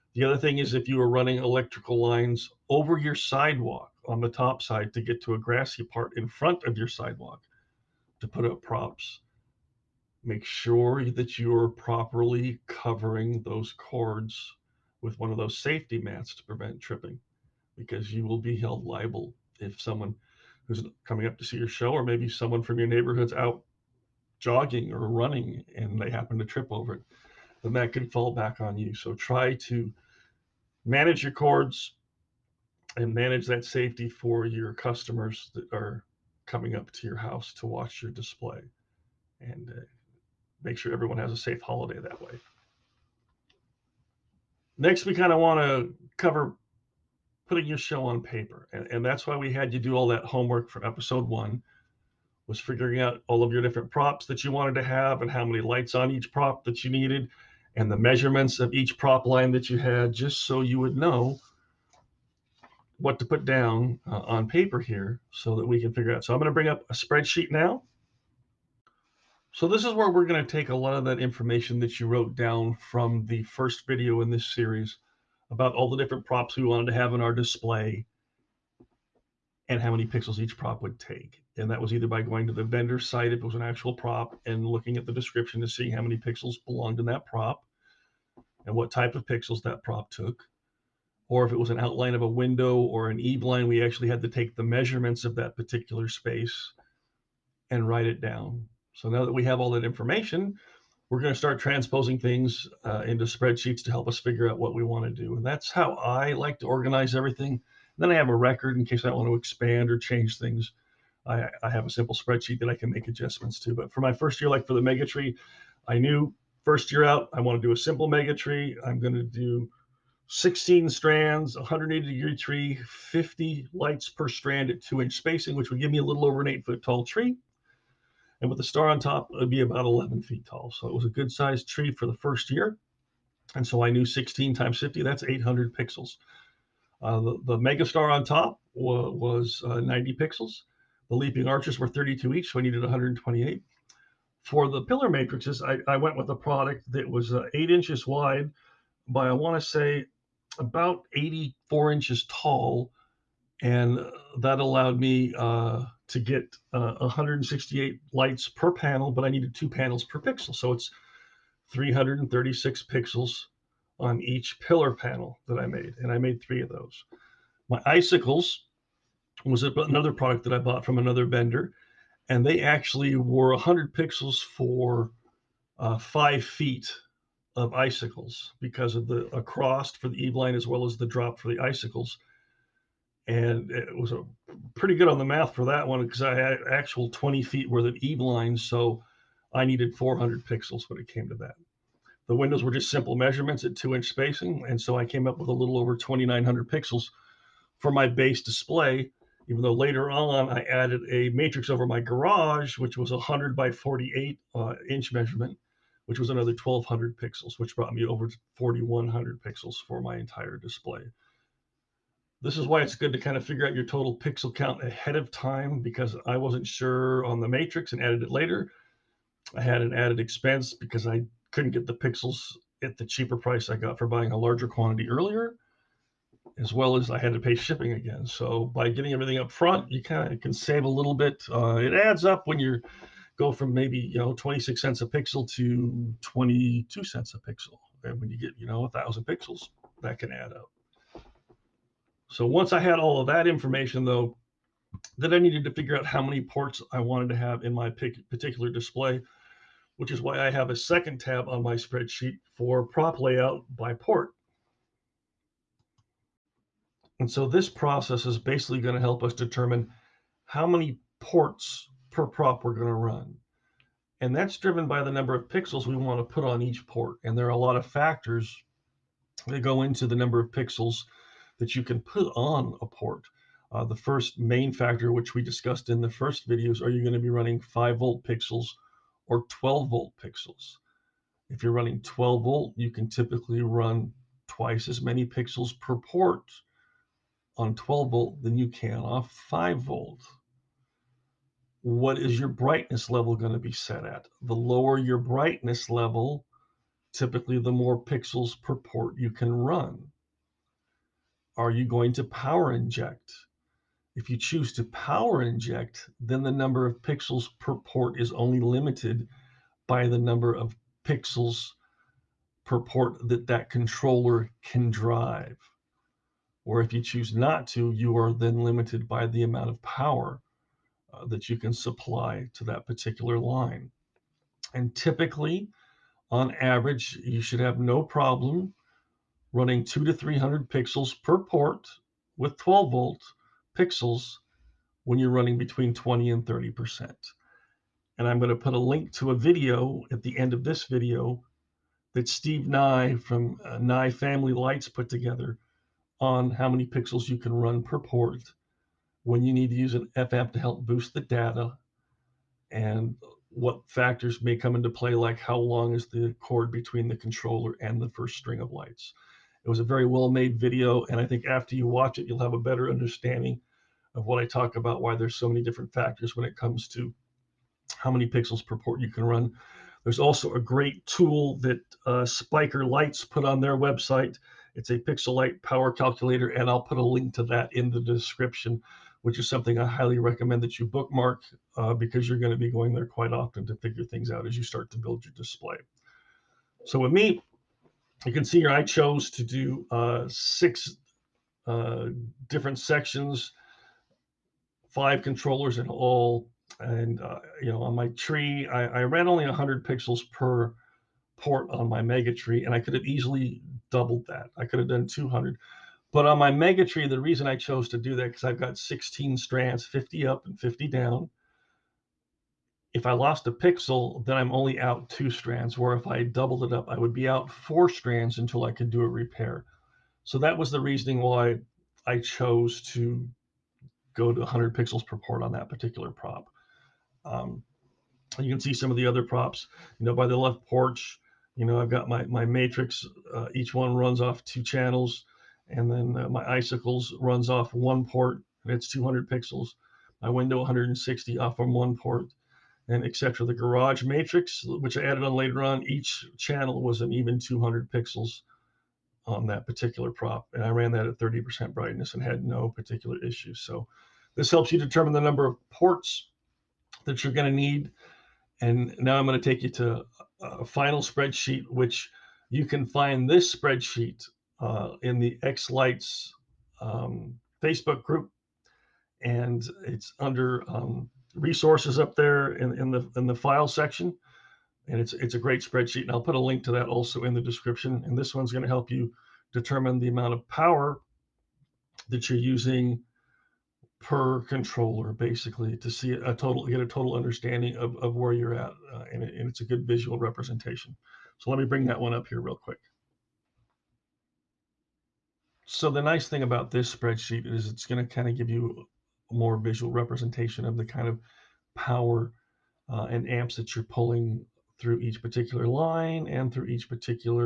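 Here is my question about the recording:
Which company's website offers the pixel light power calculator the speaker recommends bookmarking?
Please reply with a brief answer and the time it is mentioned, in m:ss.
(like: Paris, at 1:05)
Spiker Lights, at 6:12.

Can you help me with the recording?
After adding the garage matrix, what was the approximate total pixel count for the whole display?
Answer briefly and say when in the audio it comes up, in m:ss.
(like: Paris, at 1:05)
4100, at 3:28.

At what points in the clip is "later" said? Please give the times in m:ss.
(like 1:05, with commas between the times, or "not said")
3:19, 3:38, 7:25.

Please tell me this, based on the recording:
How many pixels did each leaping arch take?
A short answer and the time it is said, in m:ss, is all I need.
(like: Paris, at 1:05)
32, at 2:21.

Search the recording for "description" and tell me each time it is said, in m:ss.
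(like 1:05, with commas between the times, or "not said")
1:25, 6:18, 7:57.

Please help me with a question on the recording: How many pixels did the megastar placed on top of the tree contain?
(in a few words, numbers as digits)
90.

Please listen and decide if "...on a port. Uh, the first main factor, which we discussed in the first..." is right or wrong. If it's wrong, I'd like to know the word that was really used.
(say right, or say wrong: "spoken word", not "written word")
right.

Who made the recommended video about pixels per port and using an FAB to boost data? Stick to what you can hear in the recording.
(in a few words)
Steve Nye.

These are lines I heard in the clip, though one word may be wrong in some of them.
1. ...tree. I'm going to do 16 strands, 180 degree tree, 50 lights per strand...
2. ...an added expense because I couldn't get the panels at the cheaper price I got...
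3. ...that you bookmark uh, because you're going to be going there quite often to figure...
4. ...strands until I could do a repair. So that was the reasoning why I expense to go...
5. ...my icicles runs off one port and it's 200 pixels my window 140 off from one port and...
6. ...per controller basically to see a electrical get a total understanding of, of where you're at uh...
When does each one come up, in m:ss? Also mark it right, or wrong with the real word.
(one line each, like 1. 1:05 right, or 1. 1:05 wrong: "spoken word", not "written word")
1. 1:58 right
2. 3:39 wrong: "pixels", not "panels"
3. 6:20 right
4. 6:57 wrong: "chose", not "expense"
5. 7:16 wrong: "160", not "140"
6. 8:03 wrong: "total", not "electrical".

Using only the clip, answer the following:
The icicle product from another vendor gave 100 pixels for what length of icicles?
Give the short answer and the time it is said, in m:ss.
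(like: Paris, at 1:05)
5 feet, at 2:55.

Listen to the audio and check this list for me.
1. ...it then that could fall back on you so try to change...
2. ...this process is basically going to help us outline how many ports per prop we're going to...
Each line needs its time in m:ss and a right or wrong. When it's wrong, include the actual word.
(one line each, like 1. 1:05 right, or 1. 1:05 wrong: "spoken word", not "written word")
1. 0:26 wrong: "manage", not "change"
2. 4:17 wrong: "determine", not "outline".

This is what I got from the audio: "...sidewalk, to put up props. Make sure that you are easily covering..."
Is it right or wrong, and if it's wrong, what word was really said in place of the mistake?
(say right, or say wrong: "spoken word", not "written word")
wrong: "properly", not "easily".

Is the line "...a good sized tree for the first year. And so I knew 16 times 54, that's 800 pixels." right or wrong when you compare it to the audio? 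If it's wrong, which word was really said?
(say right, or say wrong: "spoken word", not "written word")
wrong: "50", not "54".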